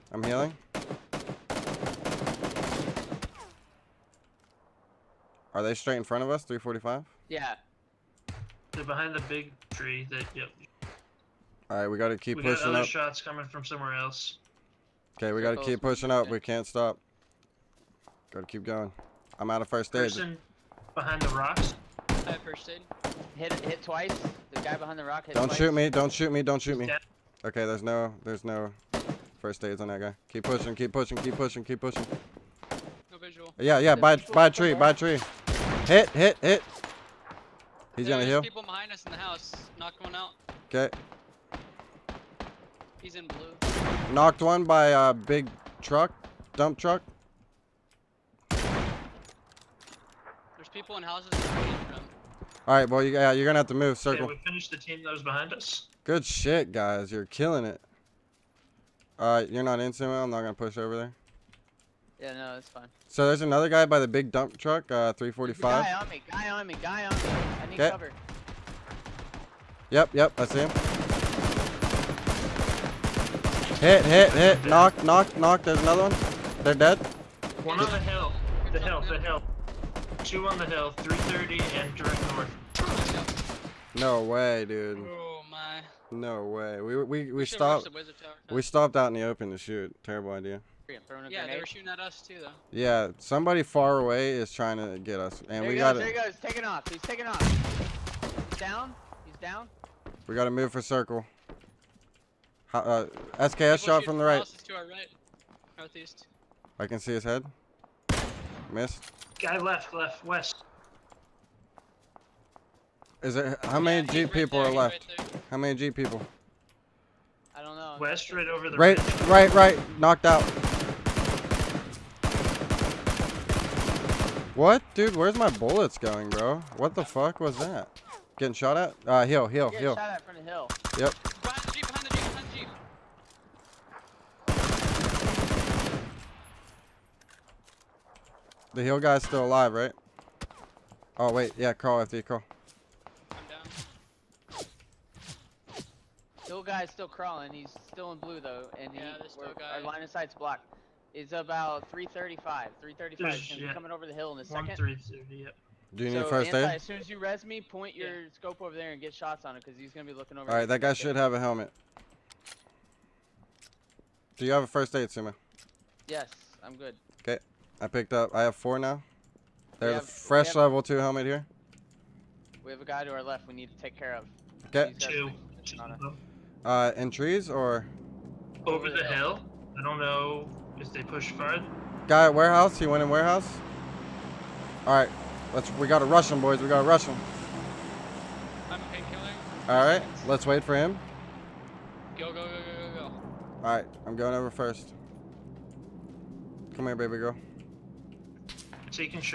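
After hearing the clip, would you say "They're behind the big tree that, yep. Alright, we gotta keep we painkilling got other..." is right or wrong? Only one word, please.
wrong.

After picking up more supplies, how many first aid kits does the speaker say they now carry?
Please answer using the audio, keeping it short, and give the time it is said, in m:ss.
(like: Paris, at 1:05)
4, at 2:48.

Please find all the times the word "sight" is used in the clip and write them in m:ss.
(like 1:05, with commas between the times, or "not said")
2:30.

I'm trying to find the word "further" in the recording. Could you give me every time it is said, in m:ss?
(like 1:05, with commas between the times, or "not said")
3:01.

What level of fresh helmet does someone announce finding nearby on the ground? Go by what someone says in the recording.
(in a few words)
Level 2.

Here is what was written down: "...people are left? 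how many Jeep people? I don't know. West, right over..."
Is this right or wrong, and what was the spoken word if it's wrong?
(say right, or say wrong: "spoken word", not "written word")
right.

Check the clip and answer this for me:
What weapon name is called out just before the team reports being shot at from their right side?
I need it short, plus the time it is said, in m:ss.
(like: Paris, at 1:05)
SKS, at 1:43.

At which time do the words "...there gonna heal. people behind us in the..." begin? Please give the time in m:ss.
0:38.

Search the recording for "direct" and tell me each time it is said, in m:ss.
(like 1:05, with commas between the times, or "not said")
1:21.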